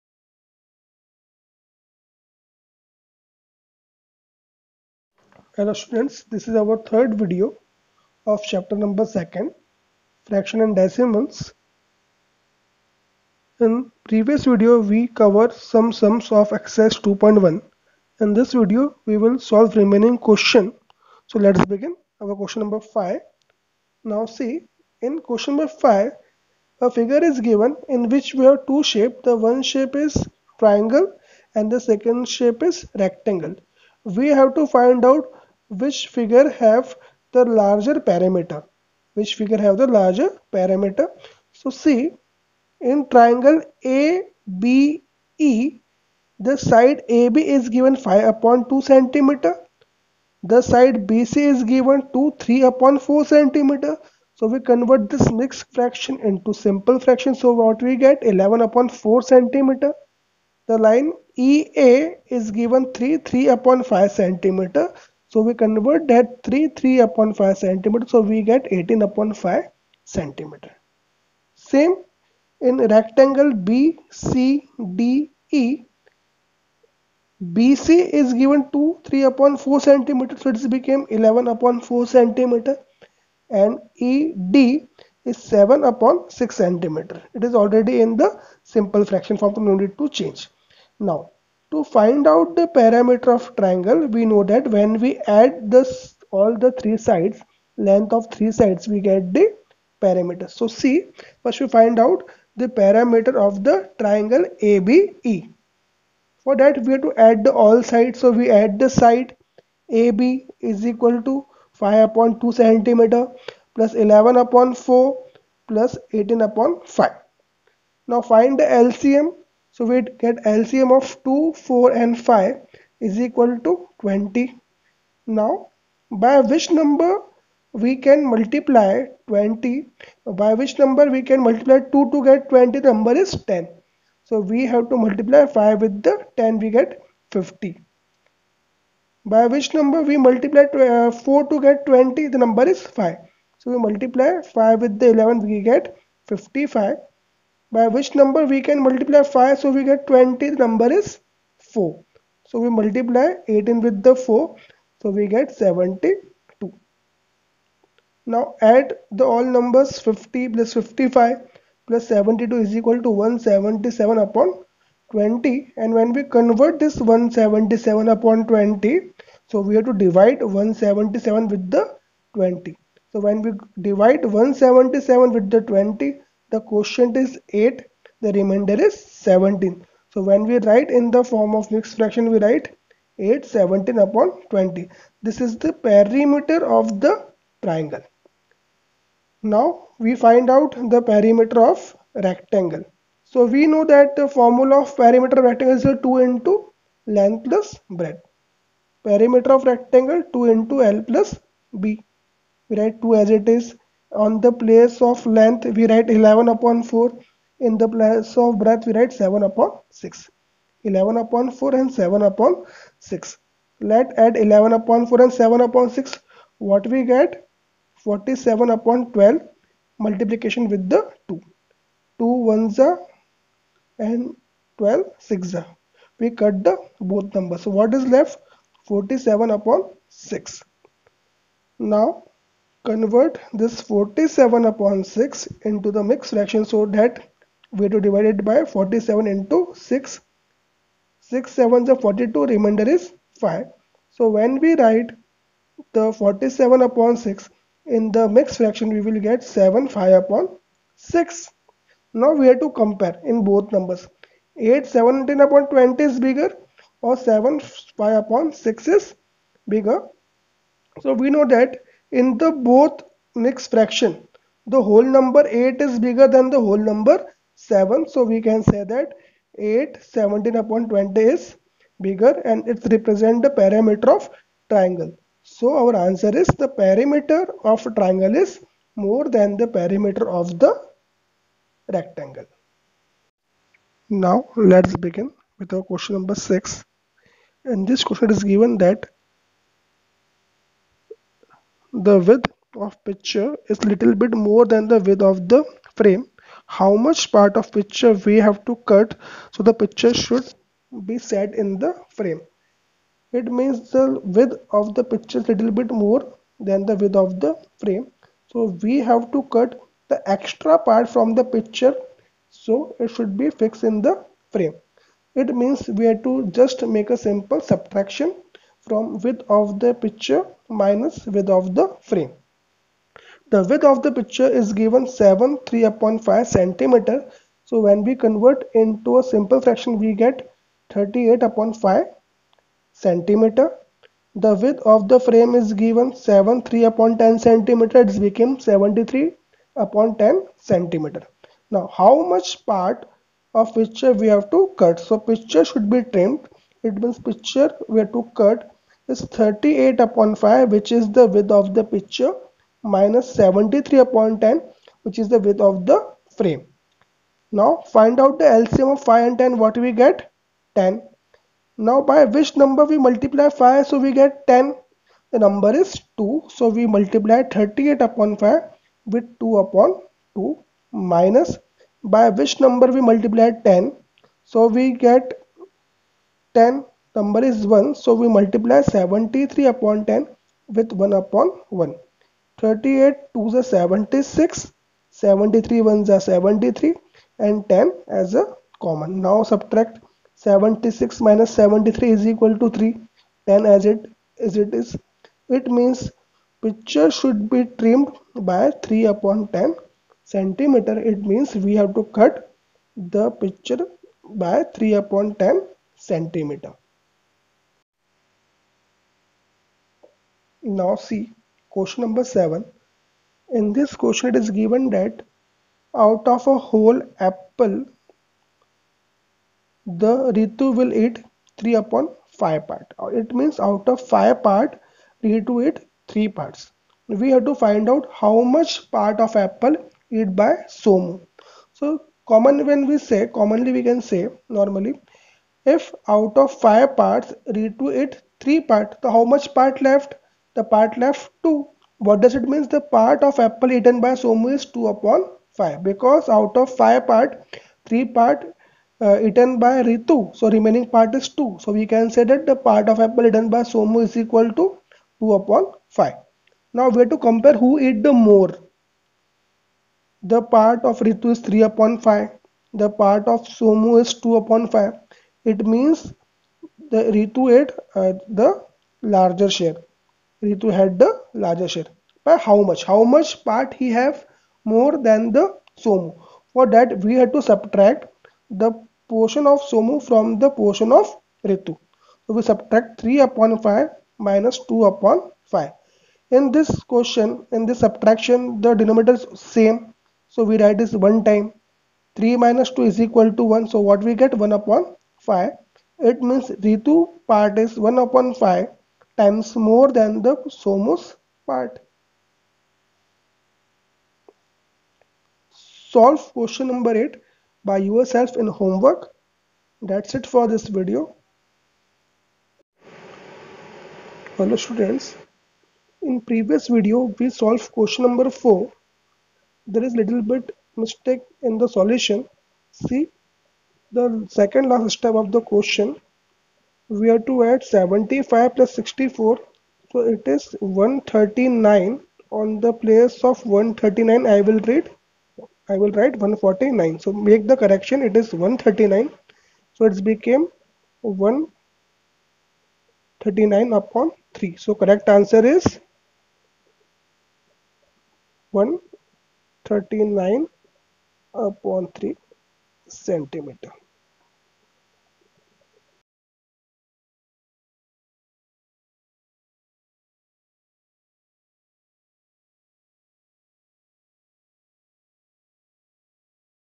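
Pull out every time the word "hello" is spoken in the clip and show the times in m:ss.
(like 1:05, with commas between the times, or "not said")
0:05, 8:34.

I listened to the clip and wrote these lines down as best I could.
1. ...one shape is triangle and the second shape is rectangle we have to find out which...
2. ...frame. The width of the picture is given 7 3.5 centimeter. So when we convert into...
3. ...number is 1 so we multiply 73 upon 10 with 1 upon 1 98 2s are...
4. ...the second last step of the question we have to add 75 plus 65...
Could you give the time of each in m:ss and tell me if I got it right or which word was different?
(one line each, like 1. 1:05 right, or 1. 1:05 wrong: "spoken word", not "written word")
1. 0:29 right
2. 5:22 right
3. 6:17 wrong: "38", not "98"
4. 8:43 wrong: "64", not "65".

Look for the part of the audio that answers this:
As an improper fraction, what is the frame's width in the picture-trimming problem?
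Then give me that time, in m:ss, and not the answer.
5:38.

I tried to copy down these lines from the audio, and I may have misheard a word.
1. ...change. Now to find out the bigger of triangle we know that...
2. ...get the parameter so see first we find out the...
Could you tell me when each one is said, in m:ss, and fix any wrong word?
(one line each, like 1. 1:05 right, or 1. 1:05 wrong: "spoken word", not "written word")
1. 1:30 wrong: "parameter", not "bigger"
2. 1:39 right.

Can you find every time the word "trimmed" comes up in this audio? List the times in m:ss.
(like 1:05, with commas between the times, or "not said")
5:46, 6:37.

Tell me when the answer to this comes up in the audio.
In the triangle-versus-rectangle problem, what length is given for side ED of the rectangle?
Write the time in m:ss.
1:25.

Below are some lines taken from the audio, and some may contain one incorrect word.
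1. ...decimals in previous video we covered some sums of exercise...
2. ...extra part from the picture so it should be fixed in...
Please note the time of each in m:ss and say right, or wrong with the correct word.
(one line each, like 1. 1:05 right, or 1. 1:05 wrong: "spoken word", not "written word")
1. 0:10 right
2. 5:10 right.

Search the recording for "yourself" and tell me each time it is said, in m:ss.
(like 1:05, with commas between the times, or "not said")
8:27.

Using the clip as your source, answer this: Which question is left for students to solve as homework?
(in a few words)
Question 8.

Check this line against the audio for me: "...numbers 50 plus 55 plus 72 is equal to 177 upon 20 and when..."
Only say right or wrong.
right.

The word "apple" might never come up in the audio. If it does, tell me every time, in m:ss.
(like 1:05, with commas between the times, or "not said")
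6:57, 7:09, 7:23, 7:32.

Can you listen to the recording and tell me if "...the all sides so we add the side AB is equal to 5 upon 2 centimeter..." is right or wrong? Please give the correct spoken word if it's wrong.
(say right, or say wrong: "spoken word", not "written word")
right.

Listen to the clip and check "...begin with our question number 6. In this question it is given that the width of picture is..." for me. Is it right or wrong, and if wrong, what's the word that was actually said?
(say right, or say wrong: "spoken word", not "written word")
right.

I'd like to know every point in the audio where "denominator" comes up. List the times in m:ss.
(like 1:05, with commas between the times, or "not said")
8:08.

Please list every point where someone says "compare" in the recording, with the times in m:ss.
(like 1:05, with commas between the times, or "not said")
4:12, 7:37.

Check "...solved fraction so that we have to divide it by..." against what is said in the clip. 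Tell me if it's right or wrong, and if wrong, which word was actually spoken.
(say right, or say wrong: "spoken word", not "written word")
wrong: "mixed", not "solved".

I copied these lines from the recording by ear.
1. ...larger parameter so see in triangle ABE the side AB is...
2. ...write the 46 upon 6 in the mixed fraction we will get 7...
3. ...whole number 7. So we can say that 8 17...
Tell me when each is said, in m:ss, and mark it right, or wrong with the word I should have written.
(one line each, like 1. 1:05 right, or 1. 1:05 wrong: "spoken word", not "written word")
1. 0:39 right
2. 4:04 wrong: "47", not "46"
3. 4:26 right.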